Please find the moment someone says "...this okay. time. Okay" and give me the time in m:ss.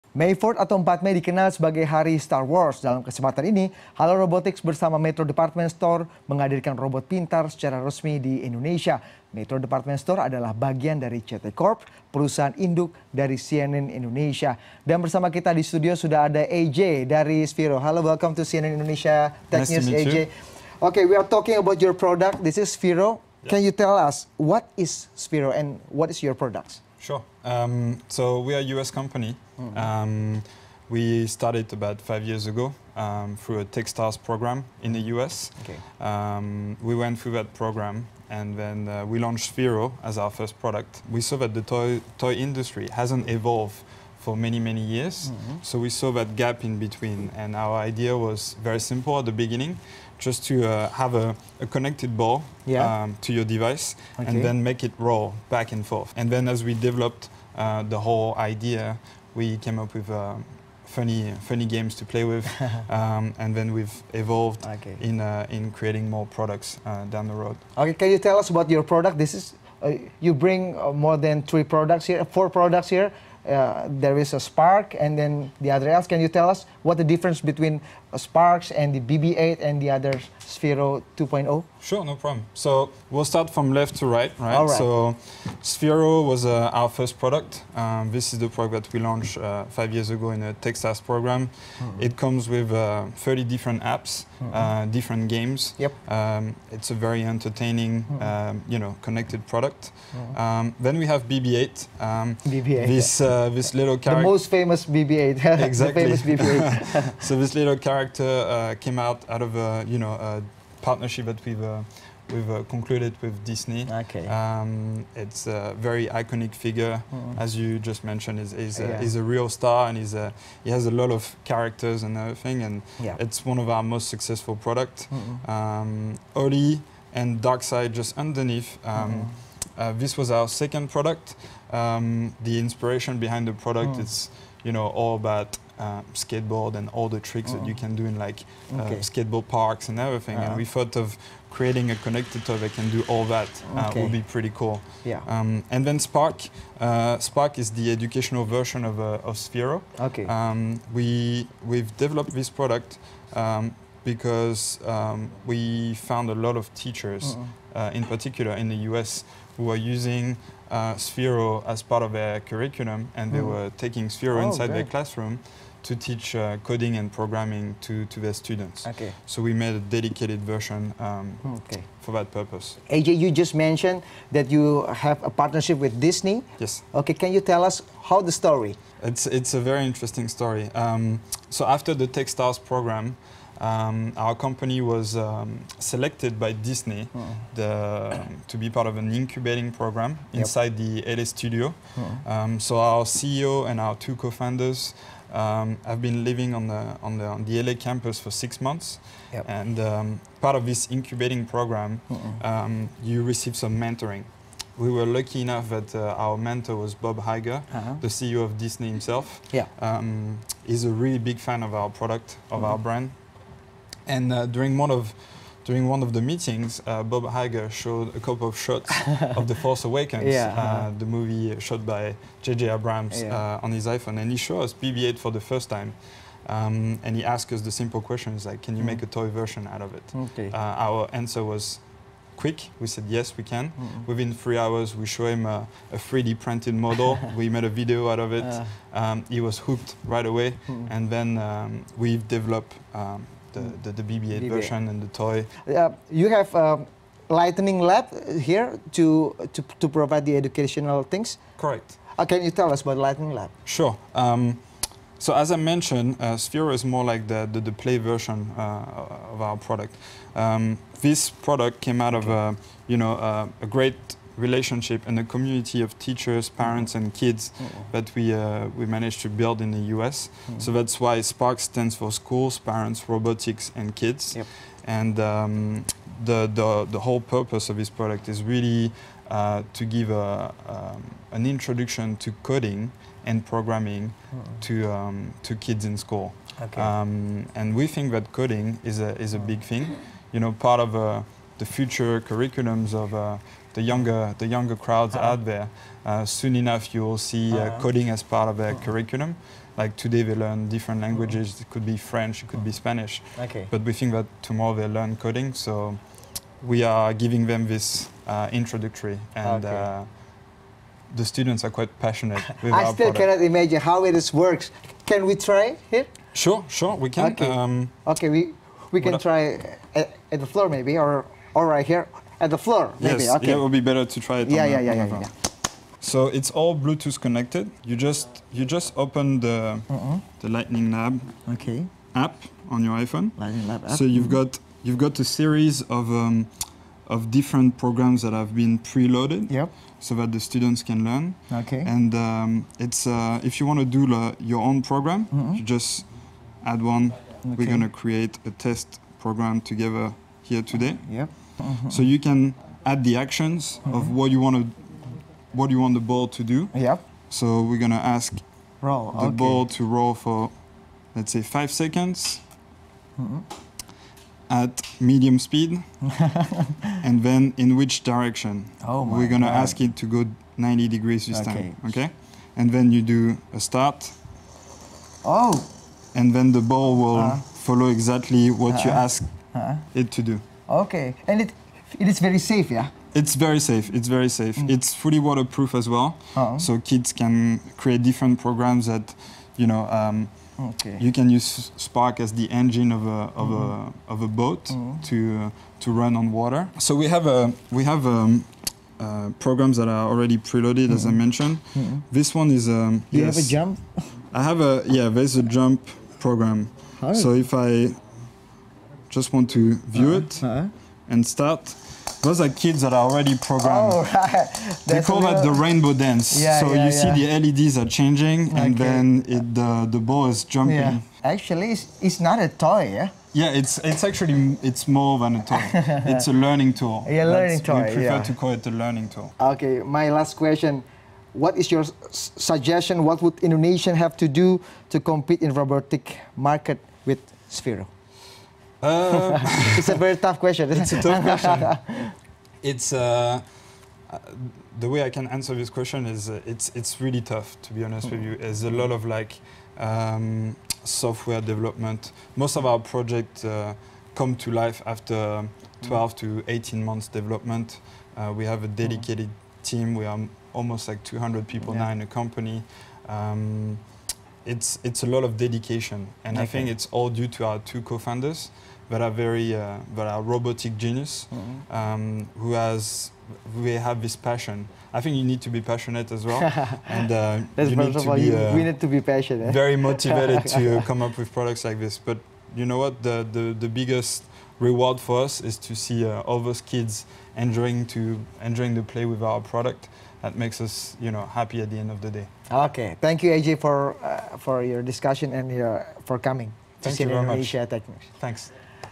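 6:11.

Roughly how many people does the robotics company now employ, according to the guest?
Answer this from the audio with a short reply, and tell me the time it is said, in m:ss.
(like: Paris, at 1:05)
200, at 7:41.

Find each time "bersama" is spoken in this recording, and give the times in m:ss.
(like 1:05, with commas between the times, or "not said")
0:04, 0:14.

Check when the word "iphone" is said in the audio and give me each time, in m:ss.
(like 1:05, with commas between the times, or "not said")
3:43, 5:33.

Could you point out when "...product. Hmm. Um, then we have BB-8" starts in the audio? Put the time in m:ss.
1:39.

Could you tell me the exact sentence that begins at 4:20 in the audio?
Um, this product came out of a, you know, a, a great relationship and a community of teachers, parents, and kids oh.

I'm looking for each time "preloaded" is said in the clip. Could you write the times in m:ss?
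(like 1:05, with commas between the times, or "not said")
5:38, 6:40.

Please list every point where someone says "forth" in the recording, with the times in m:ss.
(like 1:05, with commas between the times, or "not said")
0:55.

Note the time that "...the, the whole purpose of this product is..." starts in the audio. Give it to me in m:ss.
4:36.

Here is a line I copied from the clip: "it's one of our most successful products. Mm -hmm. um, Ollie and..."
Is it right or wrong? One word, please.
right.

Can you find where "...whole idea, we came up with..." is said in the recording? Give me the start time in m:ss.
0:57.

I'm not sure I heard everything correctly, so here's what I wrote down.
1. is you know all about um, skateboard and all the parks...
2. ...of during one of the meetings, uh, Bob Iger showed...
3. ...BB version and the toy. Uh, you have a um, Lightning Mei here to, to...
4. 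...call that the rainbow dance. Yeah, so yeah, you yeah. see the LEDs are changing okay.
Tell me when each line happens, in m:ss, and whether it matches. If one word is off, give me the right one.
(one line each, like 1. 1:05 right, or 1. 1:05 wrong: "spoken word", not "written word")
1. 2:14 wrong: "tricks", not "parks"
2. 3:34 right
3. 4:04 wrong: "Lab", not "Mei"
4. 6:55 right.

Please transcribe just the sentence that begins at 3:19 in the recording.
and um, part of this incubating program, oh.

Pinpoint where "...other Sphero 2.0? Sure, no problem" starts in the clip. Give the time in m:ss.
1:19.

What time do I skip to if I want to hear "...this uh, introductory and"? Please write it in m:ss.
5:07.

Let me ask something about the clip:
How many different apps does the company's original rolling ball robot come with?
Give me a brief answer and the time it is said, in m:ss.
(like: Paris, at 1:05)
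30, at 1:33.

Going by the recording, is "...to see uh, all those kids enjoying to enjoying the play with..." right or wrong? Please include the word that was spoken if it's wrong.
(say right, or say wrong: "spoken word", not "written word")
right.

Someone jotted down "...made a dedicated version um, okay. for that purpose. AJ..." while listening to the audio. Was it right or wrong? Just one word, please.
right.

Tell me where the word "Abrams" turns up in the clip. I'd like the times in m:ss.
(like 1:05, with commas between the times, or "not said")
3:42.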